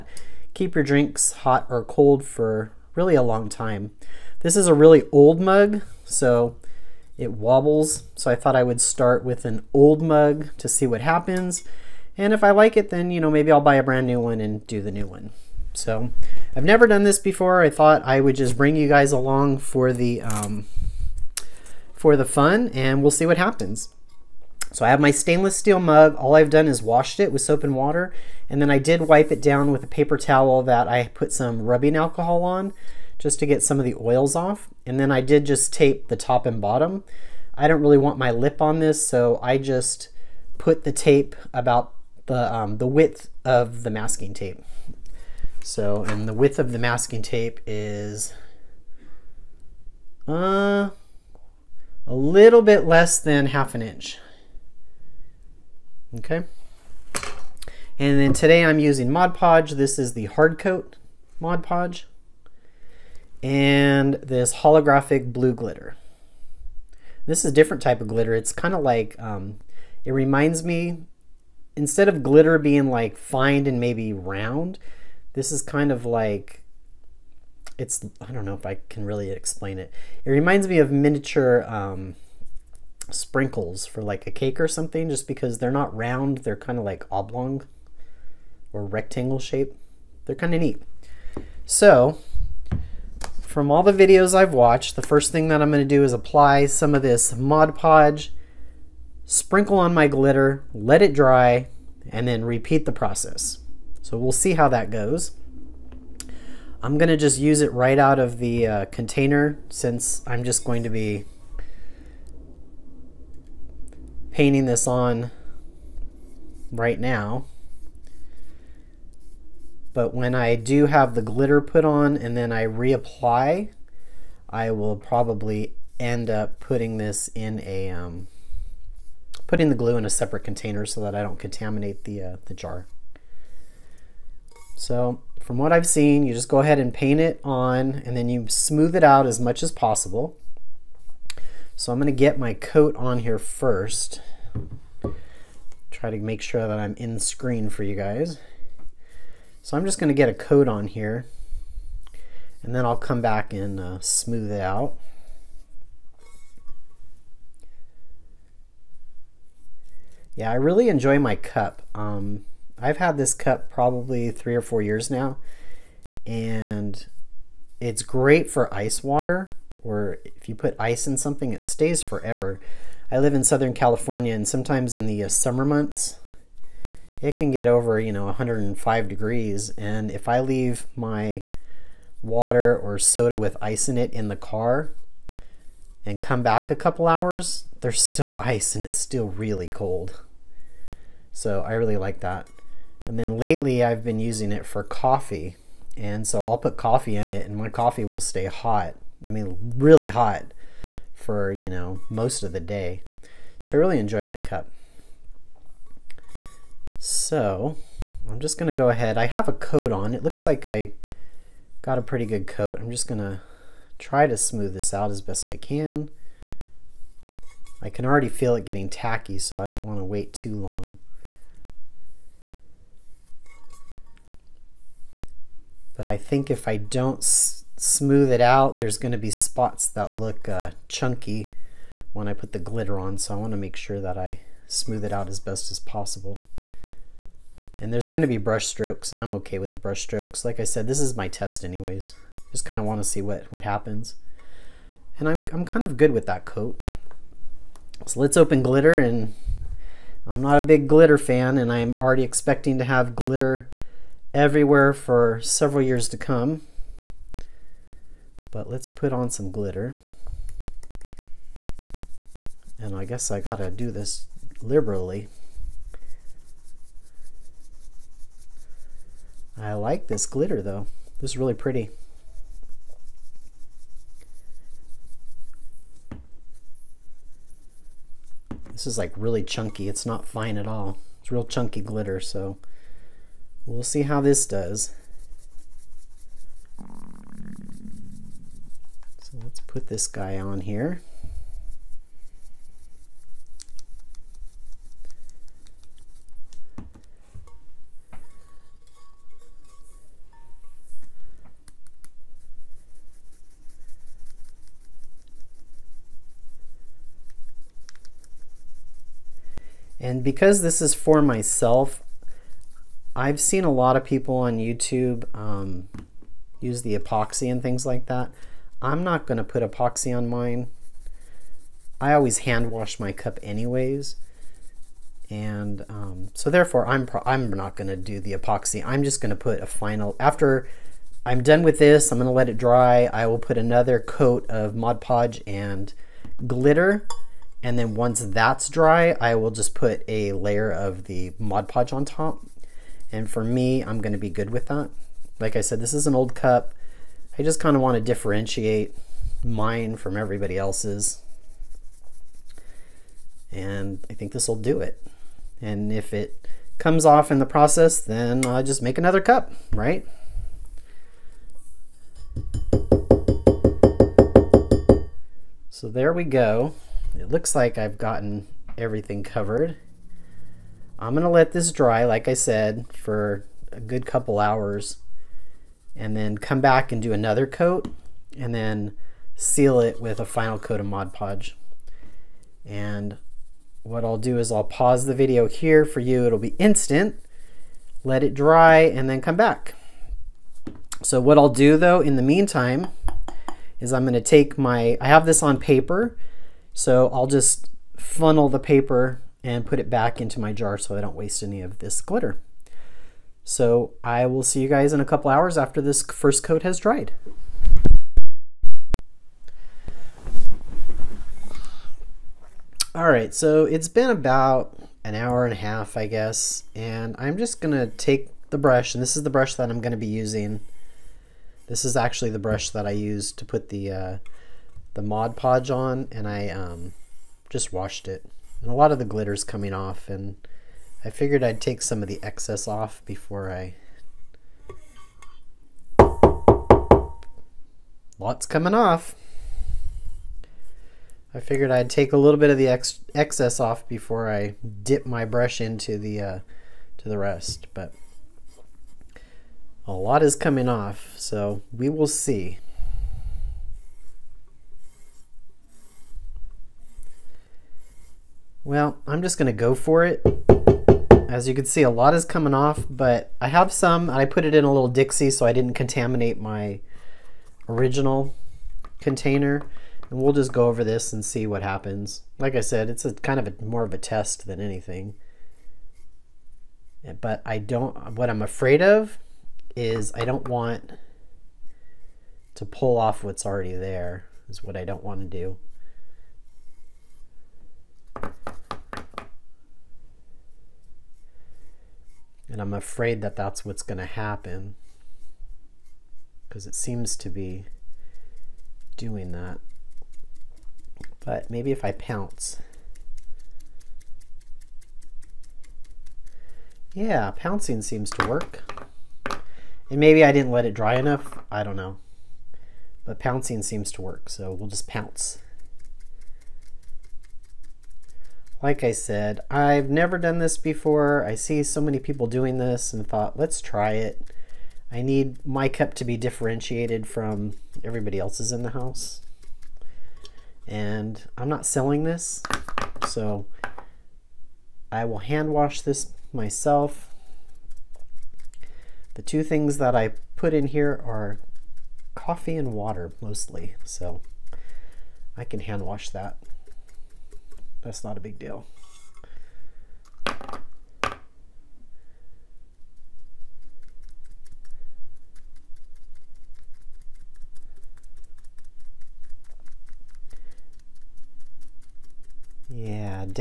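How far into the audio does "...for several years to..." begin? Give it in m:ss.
4:14.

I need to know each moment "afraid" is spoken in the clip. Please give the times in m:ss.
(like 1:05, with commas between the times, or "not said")
7:58, 8:12.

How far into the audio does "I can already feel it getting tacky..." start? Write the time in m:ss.
3:37.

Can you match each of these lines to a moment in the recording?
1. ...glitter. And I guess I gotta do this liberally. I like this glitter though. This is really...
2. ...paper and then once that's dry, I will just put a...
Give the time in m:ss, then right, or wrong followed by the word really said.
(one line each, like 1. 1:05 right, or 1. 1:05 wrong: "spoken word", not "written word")
1. 4:19 right
2. 5:36 wrong: "glitter", not "paper".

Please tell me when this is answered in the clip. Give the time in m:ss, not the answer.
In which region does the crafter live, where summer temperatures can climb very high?
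2:53.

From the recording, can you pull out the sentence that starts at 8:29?
And maybe I didn't let it dry enough.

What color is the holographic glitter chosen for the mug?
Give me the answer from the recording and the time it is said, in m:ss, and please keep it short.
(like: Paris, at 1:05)
blue, at 1:05.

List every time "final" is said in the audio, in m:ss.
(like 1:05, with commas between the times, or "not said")
5:29, 6:20.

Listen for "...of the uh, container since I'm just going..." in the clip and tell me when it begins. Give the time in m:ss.
1:48.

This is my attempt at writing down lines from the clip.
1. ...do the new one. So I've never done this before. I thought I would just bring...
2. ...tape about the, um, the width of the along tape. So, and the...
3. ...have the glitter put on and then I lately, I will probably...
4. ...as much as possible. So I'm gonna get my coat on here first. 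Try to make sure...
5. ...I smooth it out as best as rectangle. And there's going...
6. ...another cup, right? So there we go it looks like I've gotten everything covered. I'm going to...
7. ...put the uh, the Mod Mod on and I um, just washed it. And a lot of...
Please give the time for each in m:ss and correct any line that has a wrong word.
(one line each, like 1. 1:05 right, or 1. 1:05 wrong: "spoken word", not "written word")
1. 0:14 right
2. 0:40 wrong: "masking", not "along"
3. 2:00 wrong: "reapply", not "lately"
4. 2:19 right
5. 3:54 wrong: "possible", not "rectangle"
6. 5:58 right
7. 7:03 wrong: "Podge", not "Mod".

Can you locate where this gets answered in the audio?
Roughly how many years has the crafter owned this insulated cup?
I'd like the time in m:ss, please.
2:44.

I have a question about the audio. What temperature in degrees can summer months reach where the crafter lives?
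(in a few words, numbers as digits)
105 degrees.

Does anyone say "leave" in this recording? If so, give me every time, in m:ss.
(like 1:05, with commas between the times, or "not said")
3:00.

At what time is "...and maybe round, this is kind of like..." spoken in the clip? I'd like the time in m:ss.
1:13.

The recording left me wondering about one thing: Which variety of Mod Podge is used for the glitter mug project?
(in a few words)
hard coat.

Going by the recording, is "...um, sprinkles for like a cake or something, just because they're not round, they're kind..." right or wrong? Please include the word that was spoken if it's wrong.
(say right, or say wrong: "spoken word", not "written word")
right.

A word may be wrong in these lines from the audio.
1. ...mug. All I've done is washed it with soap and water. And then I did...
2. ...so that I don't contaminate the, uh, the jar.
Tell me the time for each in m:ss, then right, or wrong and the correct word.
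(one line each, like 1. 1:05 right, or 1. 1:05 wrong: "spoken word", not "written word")
1. 0:25 right
2. 2:10 right.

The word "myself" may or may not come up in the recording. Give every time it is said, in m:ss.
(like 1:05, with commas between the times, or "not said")
5:11, 8:56.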